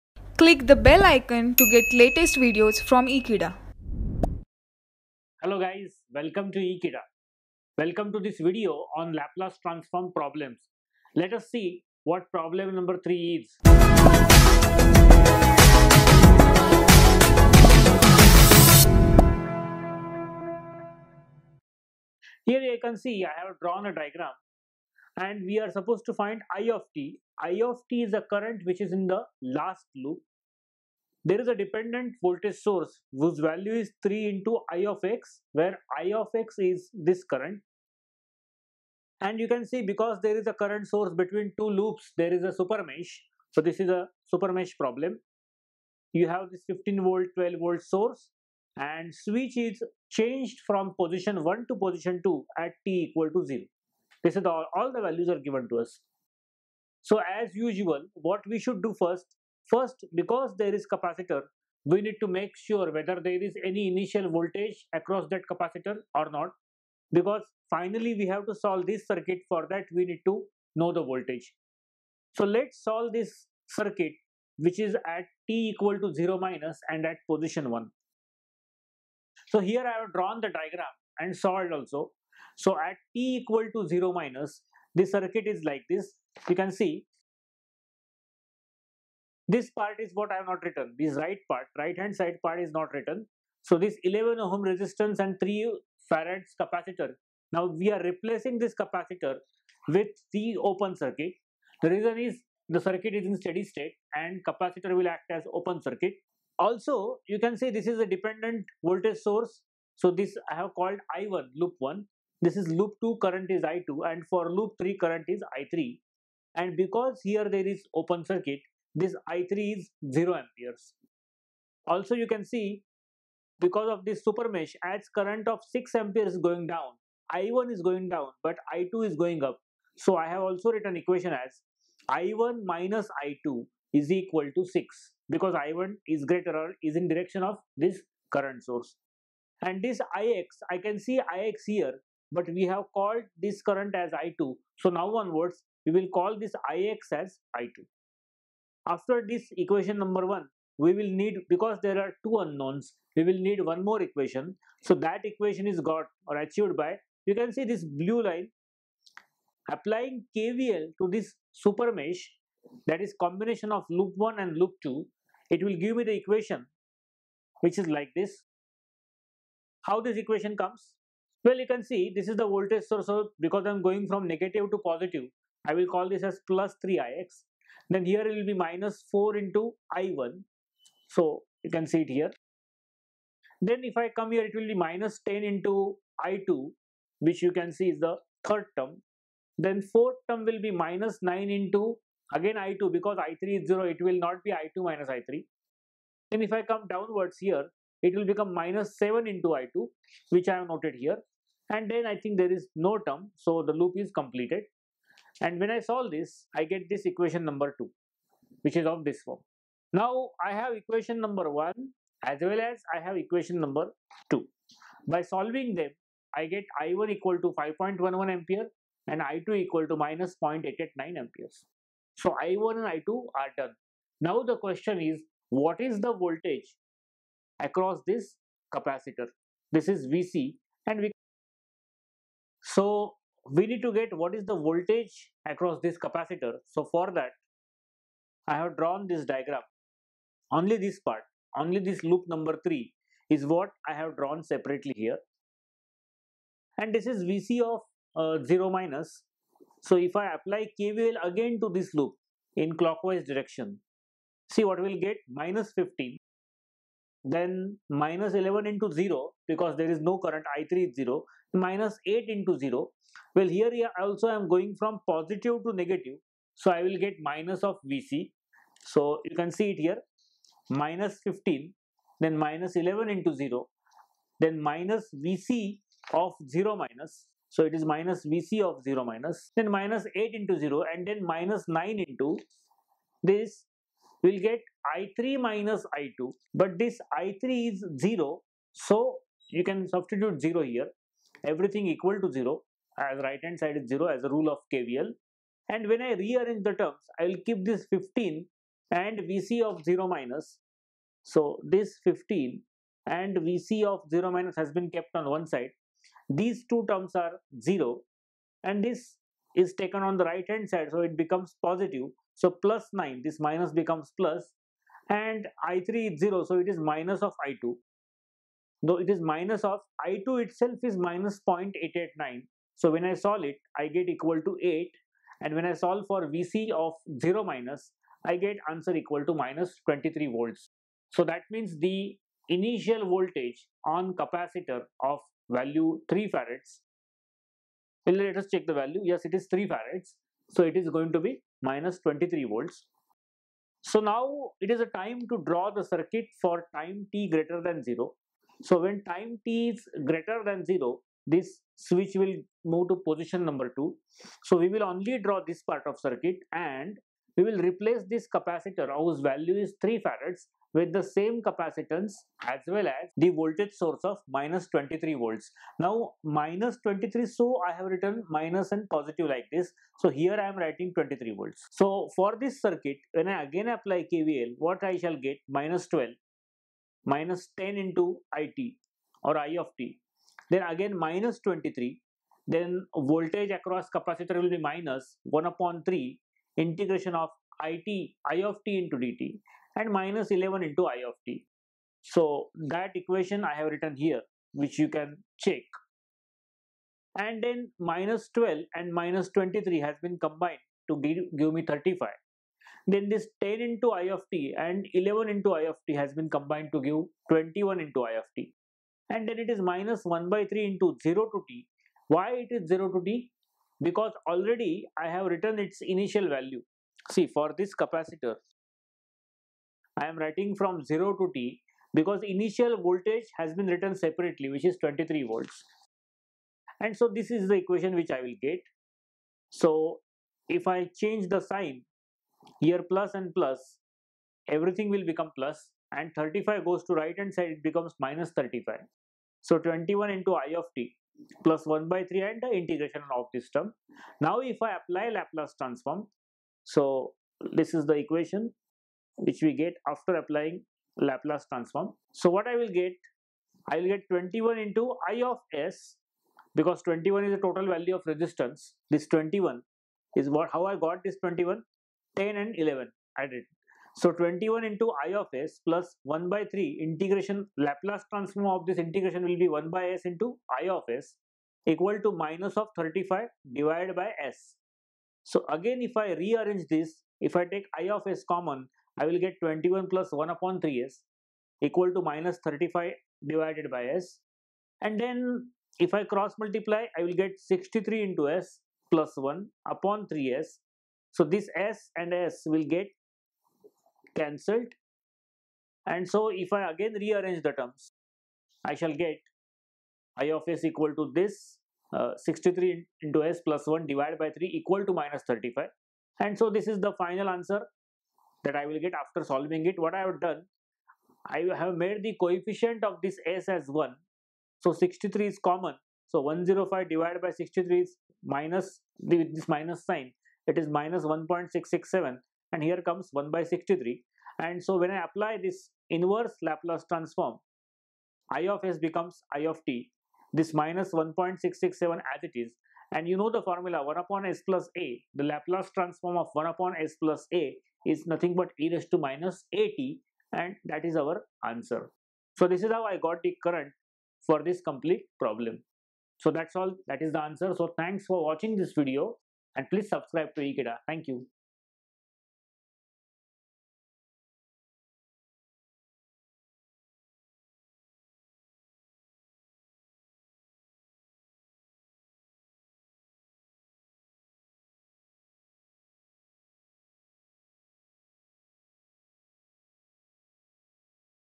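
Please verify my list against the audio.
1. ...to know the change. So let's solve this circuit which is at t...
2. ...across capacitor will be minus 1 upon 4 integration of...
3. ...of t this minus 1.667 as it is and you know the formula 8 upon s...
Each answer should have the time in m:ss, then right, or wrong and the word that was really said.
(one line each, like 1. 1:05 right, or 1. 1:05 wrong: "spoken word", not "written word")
1. 1:10 wrong: "voltage", not "change"
2. 6:23 wrong: "3", not "4"
3. 8:49 wrong: "1", not "8".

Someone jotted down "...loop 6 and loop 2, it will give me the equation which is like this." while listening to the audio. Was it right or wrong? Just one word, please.
wrong.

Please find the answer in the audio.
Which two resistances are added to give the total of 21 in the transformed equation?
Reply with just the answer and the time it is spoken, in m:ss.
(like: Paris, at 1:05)
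10 and 11, at 7:42.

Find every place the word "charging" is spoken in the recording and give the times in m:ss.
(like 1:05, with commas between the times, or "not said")
not said.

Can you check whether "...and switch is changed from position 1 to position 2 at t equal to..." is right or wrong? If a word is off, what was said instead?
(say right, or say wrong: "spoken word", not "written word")
right.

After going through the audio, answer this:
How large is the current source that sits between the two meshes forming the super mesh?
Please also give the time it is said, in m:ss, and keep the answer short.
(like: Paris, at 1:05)
6 amperes, at 2:05.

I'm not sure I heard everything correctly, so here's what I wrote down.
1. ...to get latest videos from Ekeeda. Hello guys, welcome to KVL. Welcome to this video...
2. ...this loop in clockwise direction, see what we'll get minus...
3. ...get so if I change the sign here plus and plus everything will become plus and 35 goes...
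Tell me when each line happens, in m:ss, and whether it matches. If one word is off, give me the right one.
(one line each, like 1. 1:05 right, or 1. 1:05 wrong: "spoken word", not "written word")
1. 0:01 wrong: "Ekeeda", not "KVL"
2. 4:11 right
3. 7:08 right.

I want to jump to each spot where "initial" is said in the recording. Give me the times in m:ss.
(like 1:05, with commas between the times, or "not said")
1:03, 5:32, 6:55, 7:02.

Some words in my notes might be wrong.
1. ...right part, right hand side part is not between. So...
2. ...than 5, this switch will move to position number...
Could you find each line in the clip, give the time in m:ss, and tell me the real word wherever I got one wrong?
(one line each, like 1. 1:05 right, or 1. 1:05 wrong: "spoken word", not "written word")
1. 1:31 wrong: "written", not "between"
2. 5:50 wrong: "0", not "5".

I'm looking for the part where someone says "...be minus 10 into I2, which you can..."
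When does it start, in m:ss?
3:04.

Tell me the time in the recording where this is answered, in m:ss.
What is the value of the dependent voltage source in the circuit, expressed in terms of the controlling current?
0:34.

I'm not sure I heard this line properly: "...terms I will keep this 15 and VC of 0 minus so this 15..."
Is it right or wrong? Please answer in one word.
right.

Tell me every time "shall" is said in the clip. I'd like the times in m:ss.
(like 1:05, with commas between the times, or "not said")
6:14, 8:18.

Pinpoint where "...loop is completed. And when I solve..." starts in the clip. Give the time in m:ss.
3:23.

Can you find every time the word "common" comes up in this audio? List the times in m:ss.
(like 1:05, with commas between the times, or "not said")
7:58, 8:35.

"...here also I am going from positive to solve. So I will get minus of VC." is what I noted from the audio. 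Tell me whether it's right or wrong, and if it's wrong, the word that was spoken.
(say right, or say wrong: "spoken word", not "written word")
wrong: "negative", not "solve".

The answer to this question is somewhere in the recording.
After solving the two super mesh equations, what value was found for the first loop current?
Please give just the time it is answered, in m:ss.
3:37.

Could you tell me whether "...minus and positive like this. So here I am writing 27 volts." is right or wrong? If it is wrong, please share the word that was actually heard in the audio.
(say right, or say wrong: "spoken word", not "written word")
wrong: "23", not "27".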